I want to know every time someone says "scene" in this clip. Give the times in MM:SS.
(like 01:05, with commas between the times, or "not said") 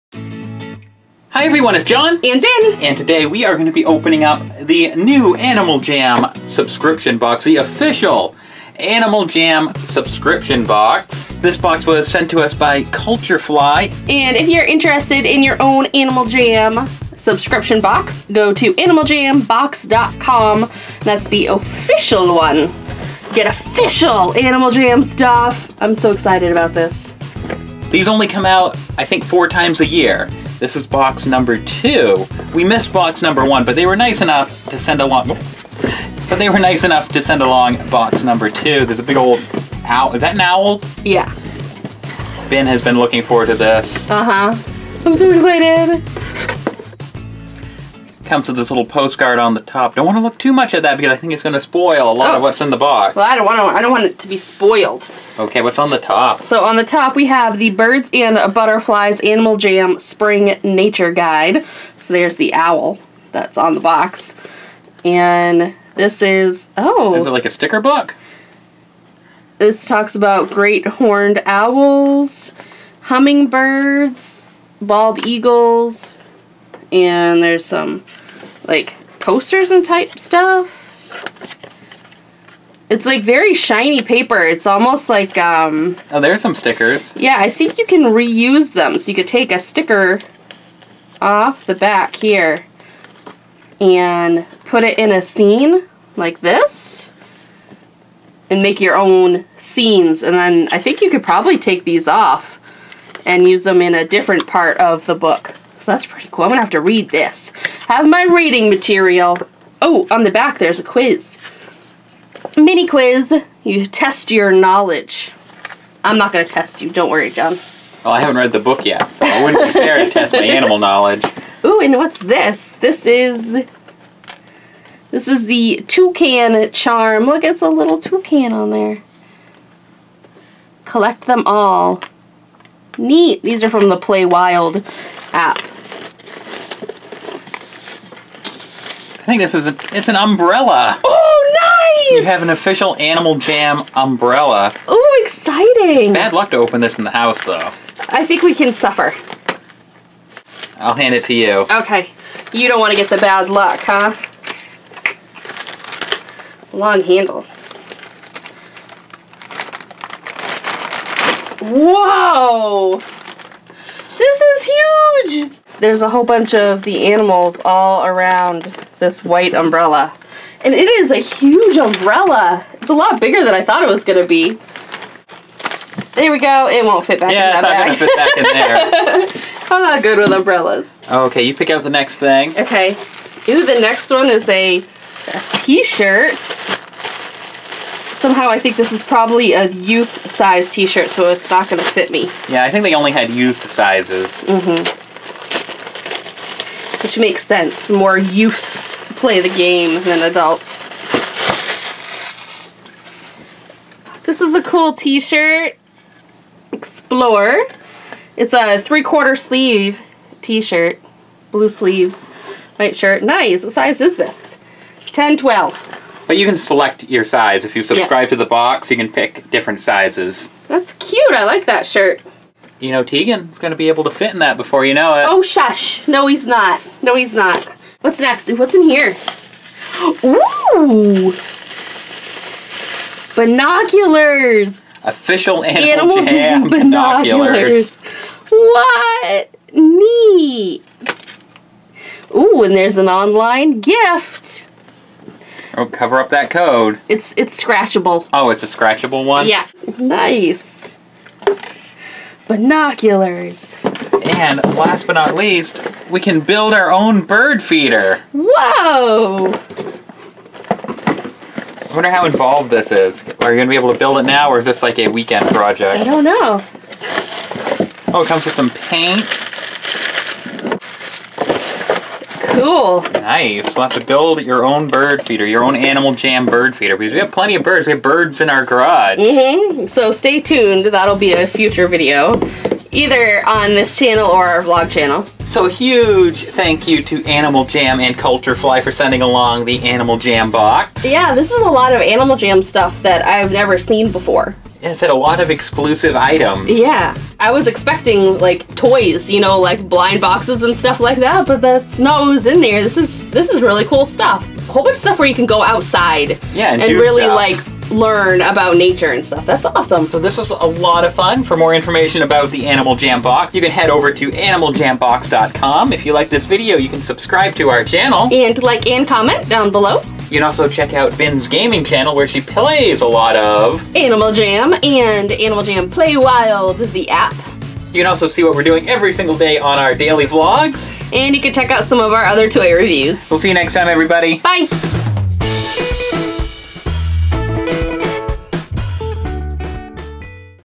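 01:35, 01:39.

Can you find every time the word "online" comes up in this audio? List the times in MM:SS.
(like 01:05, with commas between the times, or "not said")
04:03.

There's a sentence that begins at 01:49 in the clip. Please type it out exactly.
Oh, on the back there's a quiz.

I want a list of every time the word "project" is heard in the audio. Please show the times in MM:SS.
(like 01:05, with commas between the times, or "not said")
04:25.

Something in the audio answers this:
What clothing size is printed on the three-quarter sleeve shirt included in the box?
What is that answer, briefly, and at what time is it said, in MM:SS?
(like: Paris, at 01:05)
10, 12, at 03:35.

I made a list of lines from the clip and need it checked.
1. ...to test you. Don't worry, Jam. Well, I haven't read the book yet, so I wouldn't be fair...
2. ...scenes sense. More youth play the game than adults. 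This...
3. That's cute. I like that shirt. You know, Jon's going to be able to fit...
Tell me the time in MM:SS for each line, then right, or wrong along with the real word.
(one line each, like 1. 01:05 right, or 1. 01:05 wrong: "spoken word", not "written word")
1. 01:56 wrong: "Jon", not "Jam"
2. 03:17 wrong: "makes", not "scenes"
3. 03:40 wrong: "Teagan", not "Jon".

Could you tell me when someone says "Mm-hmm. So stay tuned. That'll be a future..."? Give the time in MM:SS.
04:39.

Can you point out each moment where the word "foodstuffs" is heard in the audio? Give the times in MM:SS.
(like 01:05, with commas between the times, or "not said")
not said.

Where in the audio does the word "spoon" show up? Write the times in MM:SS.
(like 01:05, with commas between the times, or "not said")
not said.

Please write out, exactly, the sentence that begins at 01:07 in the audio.
Is it like a sticker book?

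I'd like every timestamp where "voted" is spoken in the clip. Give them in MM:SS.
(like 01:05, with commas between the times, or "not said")
not said.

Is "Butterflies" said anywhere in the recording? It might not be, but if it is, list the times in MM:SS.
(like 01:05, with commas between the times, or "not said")
00:58.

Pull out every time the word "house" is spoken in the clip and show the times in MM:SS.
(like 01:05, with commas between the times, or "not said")
02:27.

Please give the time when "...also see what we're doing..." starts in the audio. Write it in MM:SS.
05:28.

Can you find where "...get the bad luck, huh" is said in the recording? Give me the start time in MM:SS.
02:32.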